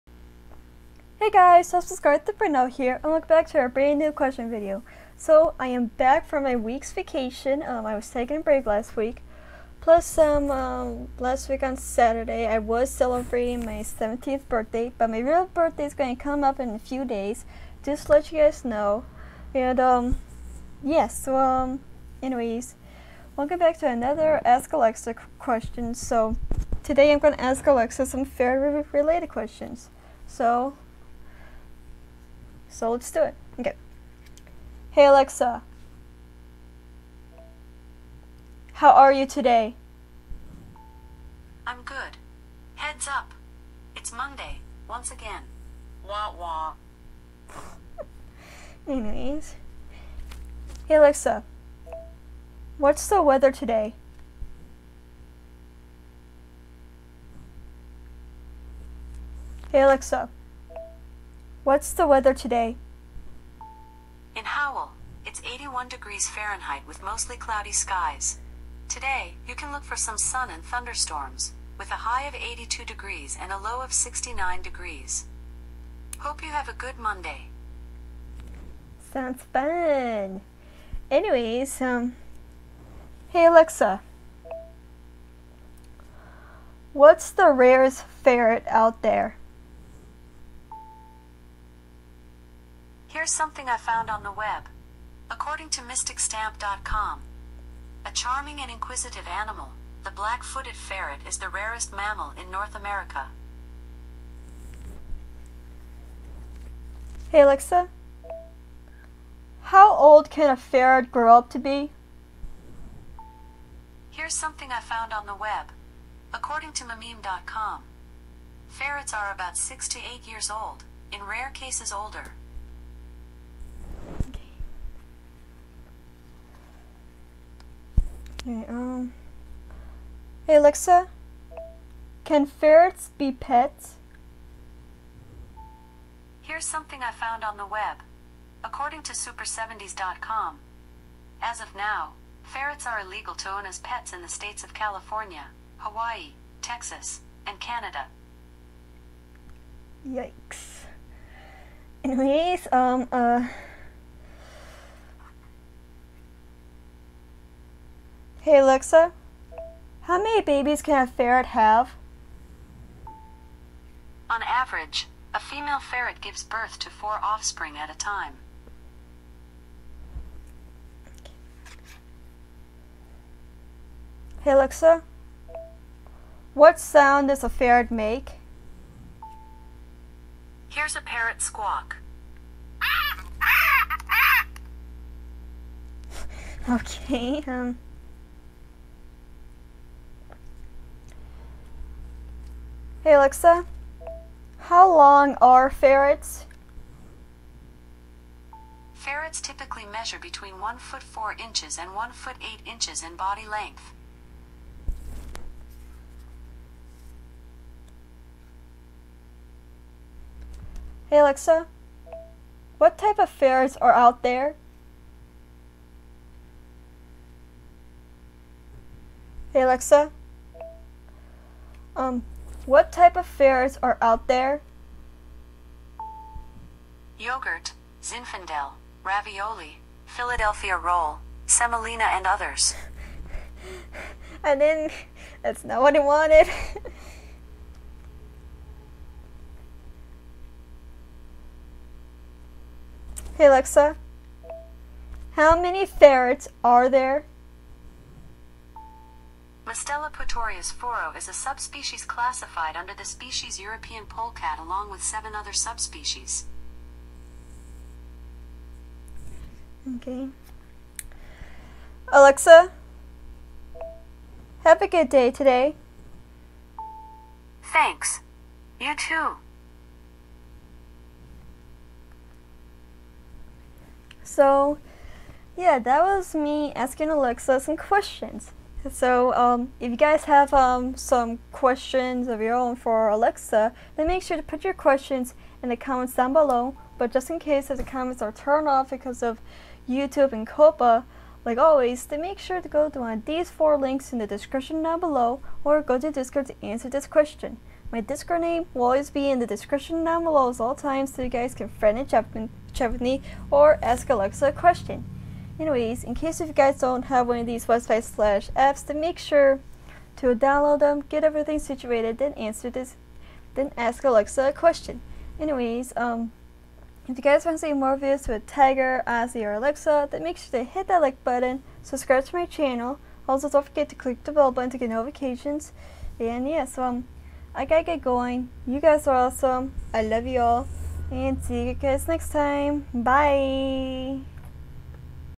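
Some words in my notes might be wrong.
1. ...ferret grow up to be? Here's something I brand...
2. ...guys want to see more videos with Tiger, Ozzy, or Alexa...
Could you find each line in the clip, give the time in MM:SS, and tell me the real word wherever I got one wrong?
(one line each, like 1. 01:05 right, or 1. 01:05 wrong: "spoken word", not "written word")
1. 01:50 wrong: "found", not "brand"
2. 05:17 right.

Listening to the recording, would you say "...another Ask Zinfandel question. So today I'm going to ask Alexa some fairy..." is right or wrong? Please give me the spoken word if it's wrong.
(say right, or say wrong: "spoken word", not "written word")
wrong: "Alexa", not "Zinfandel".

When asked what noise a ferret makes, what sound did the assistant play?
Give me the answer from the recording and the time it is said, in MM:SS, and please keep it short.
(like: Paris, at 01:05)
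parrot squawk, at 03:01.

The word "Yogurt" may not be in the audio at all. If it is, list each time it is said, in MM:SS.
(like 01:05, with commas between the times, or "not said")
03:47.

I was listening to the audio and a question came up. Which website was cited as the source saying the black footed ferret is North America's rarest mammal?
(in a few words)
mysticstamp.com.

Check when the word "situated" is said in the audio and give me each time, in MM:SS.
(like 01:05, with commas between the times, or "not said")
05:11.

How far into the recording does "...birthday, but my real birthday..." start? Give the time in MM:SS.
00:14.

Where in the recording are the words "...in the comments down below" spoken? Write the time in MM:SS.
04:45.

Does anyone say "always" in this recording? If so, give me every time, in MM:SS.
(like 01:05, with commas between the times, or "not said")
04:51, 04:58.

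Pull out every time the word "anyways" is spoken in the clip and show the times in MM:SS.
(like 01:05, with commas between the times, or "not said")
00:22, 00:48, 01:21, 02:32, 05:05, 05:15.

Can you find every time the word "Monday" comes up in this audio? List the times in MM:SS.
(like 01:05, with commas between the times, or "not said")
00:44, 01:16.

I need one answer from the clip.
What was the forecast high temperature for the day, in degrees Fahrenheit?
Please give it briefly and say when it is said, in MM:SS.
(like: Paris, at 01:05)
82, at 01:12.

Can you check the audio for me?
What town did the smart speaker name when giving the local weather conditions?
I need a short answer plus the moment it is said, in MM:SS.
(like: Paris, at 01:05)
Howell, at 01:04.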